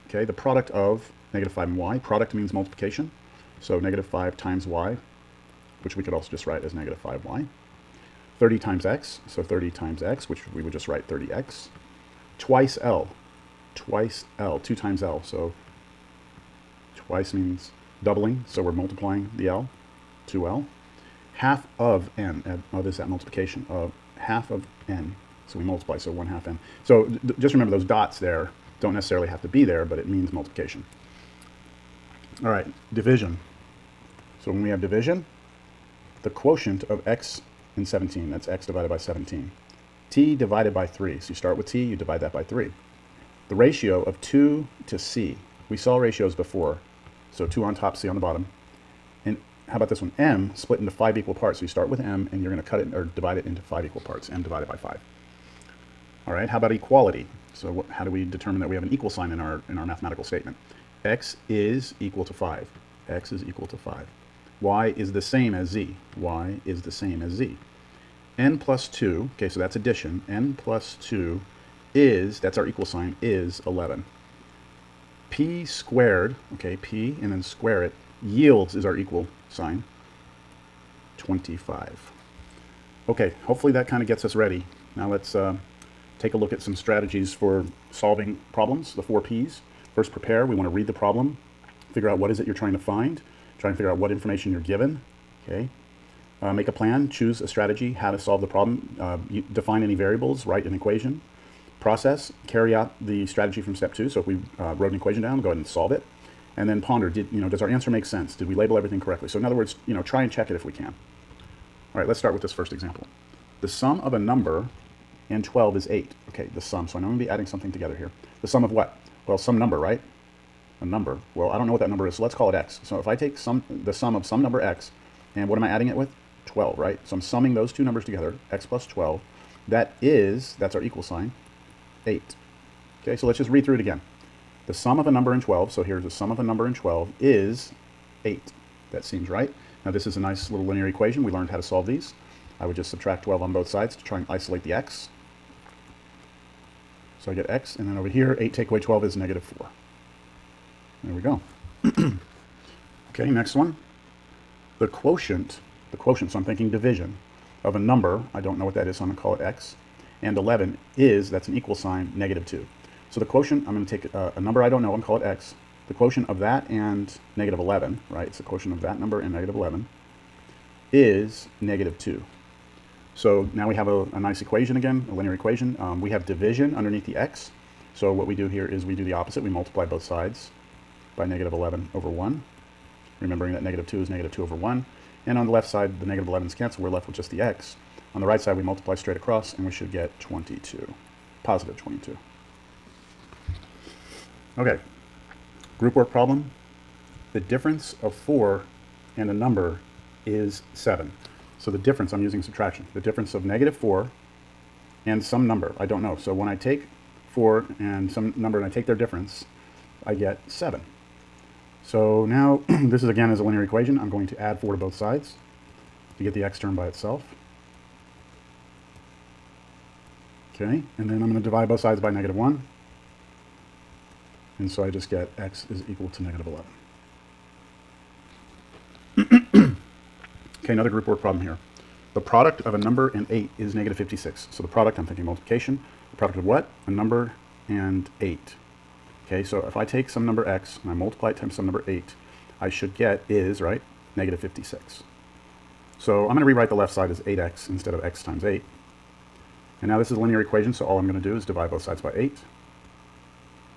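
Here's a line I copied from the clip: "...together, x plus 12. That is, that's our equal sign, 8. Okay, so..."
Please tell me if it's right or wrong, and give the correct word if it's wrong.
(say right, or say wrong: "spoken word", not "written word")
right.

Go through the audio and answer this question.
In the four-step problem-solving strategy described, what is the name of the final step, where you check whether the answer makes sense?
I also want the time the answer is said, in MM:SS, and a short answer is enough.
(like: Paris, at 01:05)
Ponder, at 01:46.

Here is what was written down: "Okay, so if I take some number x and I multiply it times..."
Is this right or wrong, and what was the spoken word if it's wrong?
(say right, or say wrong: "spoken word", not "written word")
right.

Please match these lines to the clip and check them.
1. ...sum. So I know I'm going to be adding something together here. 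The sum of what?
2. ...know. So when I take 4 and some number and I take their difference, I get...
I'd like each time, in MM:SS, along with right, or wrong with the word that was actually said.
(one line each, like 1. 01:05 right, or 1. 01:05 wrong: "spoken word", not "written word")
1. 01:56 right
2. 03:26 right.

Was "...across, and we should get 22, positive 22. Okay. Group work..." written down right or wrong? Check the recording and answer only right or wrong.
right.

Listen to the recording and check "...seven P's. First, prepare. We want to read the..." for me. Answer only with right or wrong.
wrong.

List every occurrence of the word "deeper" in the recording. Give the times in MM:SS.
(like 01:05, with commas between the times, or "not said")
not said.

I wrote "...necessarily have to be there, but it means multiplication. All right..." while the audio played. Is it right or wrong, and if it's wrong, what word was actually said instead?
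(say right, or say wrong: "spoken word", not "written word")
right.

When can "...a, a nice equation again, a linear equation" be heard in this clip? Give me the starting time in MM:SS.
02:53.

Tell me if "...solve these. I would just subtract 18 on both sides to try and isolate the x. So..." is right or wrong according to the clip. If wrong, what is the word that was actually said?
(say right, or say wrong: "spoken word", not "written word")
wrong: "12", not "18".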